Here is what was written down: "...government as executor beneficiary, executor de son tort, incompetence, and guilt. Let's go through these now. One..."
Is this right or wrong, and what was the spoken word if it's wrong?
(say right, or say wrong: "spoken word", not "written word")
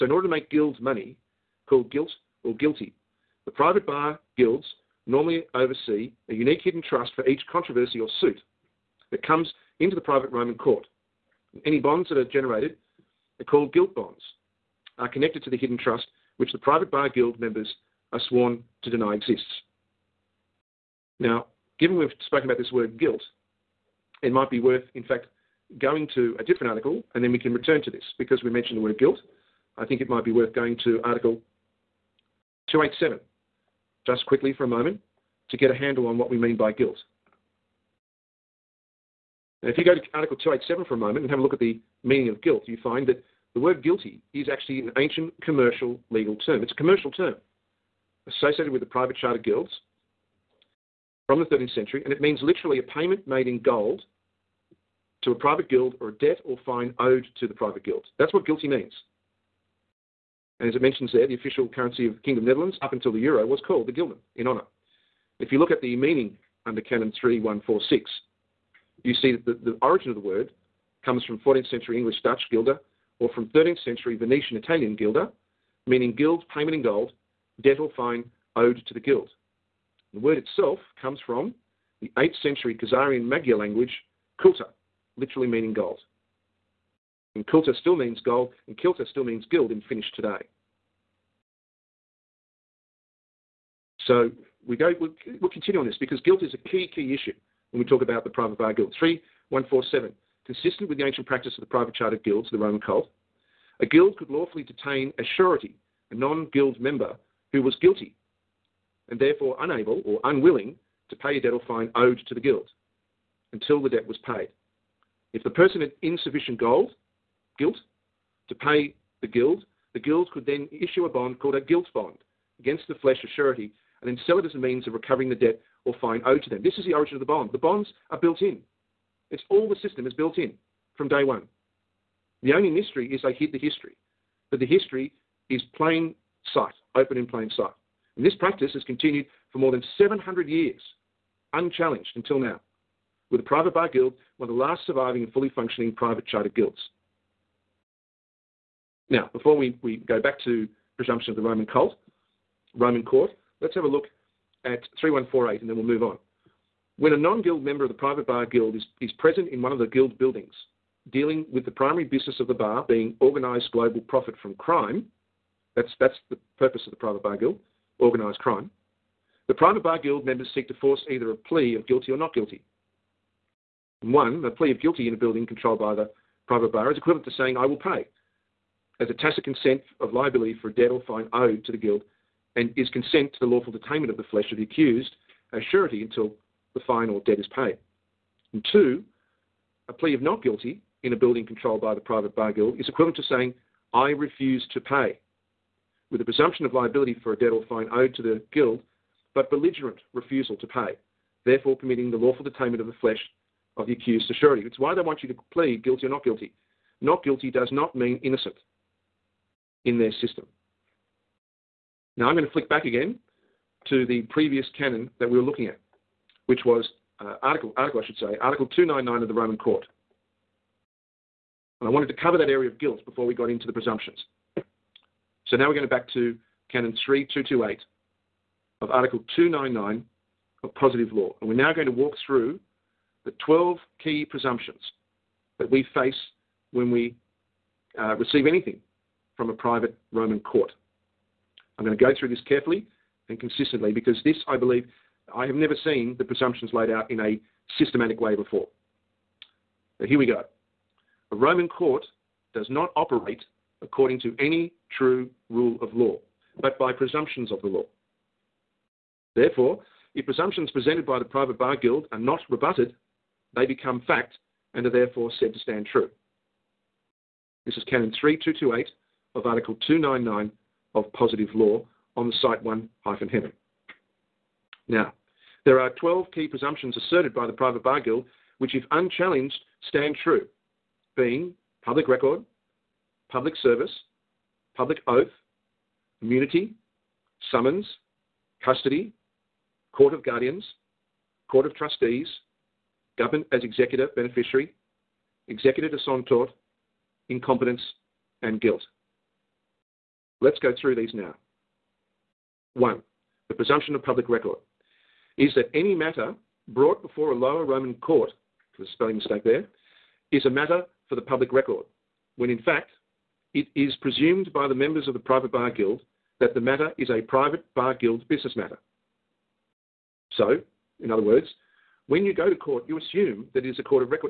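right.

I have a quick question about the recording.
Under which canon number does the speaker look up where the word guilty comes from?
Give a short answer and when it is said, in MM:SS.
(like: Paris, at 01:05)
Canon 3146, at 01:06.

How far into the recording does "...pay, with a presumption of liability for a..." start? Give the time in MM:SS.
03:14.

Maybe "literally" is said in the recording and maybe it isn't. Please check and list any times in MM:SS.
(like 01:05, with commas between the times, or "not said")
00:52, 01:25.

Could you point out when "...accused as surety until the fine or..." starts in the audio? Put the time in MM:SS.
03:04.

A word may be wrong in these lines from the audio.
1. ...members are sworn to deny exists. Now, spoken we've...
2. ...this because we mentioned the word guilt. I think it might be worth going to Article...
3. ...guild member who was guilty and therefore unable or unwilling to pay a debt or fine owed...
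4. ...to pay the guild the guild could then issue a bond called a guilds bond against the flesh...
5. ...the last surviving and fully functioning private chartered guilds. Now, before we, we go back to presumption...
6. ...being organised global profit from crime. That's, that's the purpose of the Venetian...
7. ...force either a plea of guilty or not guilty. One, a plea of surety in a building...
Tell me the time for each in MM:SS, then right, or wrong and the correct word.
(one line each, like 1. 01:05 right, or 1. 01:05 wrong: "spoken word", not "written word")
1. 00:17 wrong: "given", not "spoken"
2. 00:27 right
3. 01:46 right
4. 01:58 right
5. 02:24 right
6. 02:42 wrong: "Private", not "Venetian"
7. 02:50 wrong: "guilty", not "surety".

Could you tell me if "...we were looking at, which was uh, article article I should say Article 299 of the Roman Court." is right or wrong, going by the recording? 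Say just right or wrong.
right.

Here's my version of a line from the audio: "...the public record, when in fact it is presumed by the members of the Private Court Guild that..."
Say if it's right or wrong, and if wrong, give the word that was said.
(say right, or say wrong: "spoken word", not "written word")
wrong: "Bar", not "Court".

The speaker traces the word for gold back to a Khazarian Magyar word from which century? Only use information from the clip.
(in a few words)
8th century.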